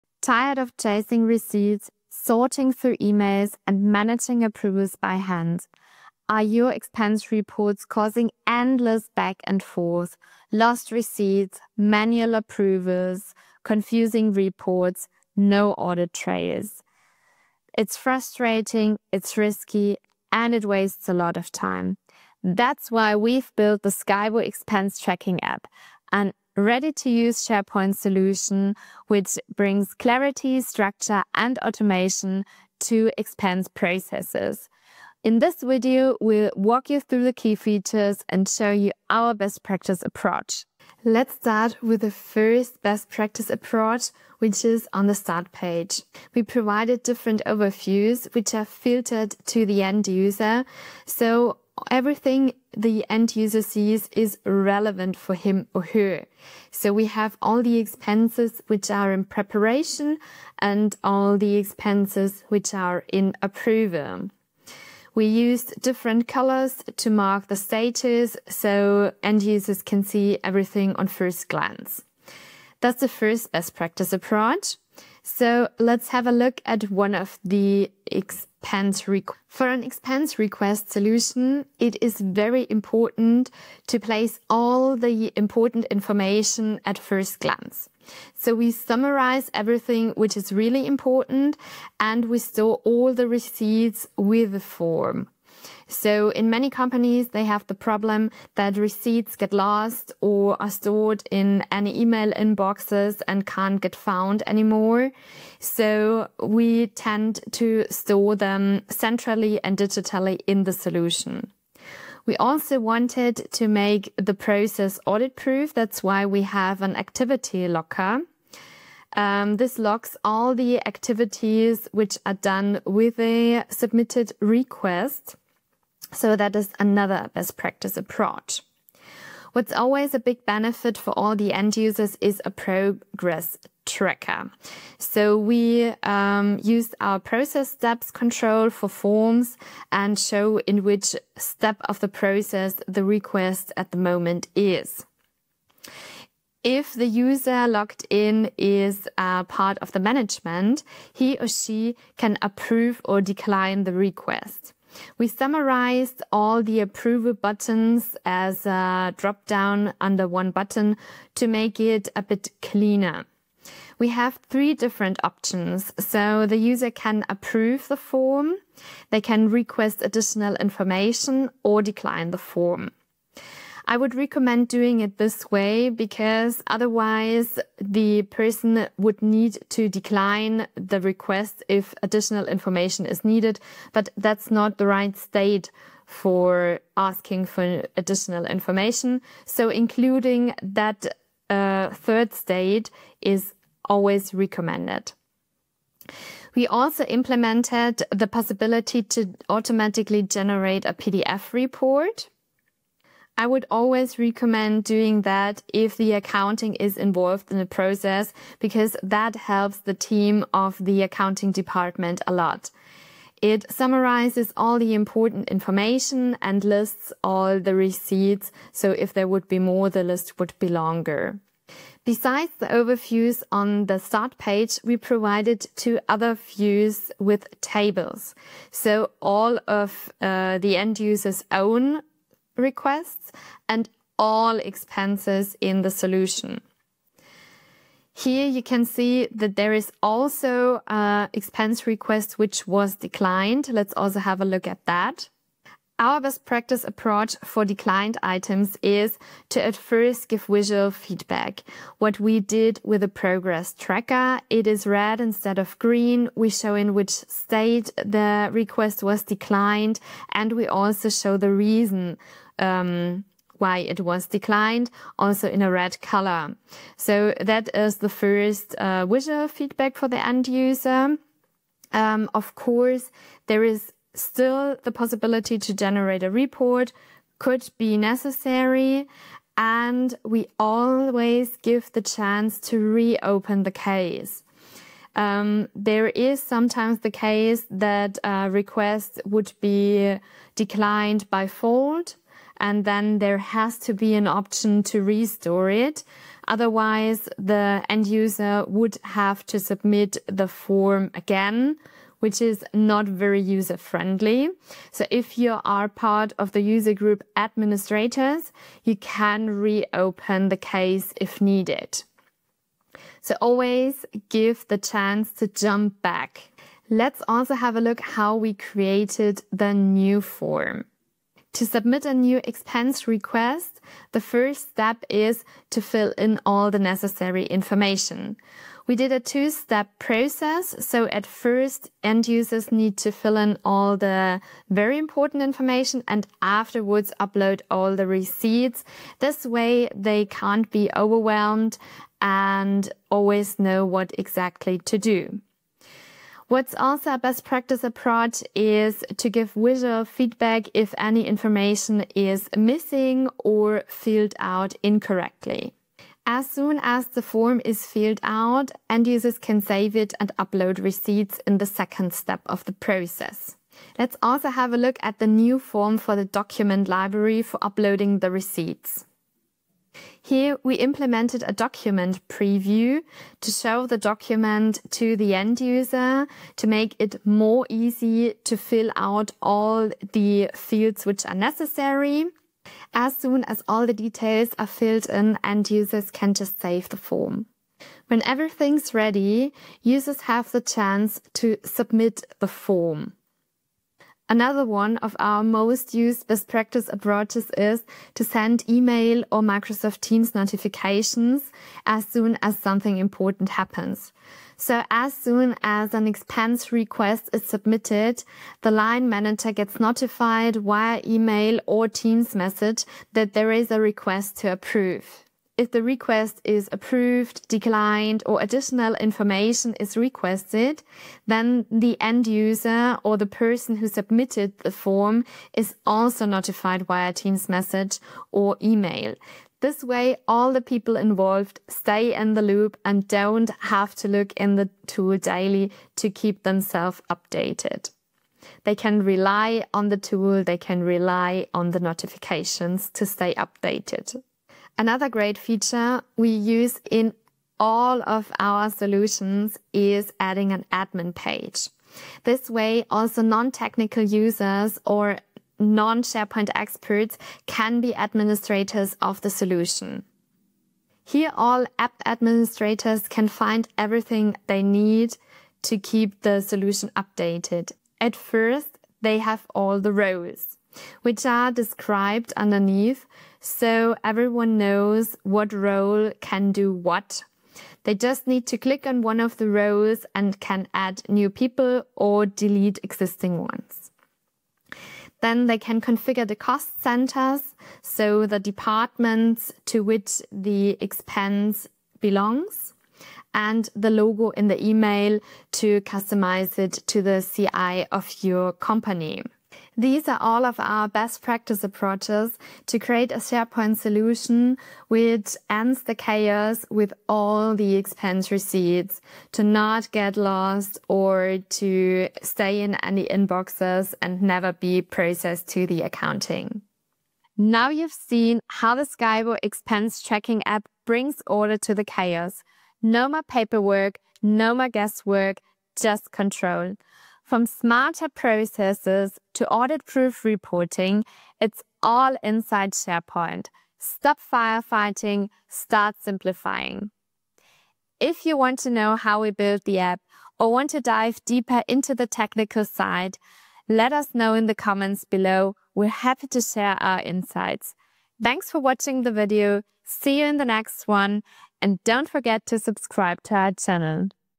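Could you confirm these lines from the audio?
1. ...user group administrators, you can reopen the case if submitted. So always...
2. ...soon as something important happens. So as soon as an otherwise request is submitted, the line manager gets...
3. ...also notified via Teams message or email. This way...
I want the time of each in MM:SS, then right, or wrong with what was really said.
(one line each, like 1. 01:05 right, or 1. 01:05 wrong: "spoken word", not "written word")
1. 05:06 wrong: "needed", not "submitted"
2. 06:42 wrong: "expense", not "otherwise"
3. 07:05 right.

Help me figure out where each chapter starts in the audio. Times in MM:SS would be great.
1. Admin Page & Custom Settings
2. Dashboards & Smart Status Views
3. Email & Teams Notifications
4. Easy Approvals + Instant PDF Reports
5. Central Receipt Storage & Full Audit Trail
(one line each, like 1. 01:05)
1. 07:19
2. 00:36
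3. 06:46
4. 02:54
5. 01:30.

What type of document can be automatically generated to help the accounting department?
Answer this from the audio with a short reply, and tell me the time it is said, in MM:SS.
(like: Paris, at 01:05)
PDF report, at 03:20.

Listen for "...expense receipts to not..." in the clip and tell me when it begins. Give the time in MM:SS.
08:27.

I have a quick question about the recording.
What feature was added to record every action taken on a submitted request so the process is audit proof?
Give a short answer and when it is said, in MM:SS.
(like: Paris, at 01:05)
Activity logger, at 01:56.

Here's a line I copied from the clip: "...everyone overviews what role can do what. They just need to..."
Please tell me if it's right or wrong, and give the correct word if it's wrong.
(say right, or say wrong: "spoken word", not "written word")
wrong: "knows", not "overviews".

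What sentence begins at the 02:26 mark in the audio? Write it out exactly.
If the user logged in is uh, part of the management, he or she can approve or decline the request.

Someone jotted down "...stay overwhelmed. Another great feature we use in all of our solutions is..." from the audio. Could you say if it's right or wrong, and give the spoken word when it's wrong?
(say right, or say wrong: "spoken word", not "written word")
wrong: "updated", not "overwhelmed".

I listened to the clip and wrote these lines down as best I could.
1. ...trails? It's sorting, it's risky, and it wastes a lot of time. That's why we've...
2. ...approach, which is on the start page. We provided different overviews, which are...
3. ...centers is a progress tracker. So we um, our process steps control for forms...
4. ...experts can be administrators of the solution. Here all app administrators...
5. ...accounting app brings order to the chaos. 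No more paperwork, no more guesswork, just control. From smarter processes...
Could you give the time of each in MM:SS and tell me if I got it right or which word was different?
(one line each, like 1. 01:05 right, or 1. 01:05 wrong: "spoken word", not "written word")
1. 00:16 wrong: "frustrating", not "sorting"
2. 00:43 right
3. 02:11 wrong: "users", not "centers"
4. 07:36 right
5. 08:40 wrong: "tracking", not "accounting".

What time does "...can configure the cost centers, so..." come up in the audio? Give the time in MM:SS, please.
08:05.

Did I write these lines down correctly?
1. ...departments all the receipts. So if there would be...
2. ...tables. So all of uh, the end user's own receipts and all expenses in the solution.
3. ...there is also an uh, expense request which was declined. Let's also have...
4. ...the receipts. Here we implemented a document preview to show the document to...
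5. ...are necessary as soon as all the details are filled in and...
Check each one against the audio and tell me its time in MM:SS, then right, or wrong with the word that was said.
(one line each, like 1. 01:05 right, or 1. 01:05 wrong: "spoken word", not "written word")
1. 03:36 wrong: "lists", not "departments"
2. 03:47 wrong: "requests", not "receipts"
3. 03:59 right
4. 06:08 right
5. 06:21 right.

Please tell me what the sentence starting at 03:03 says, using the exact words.
But that's not the right state for asking for additional information.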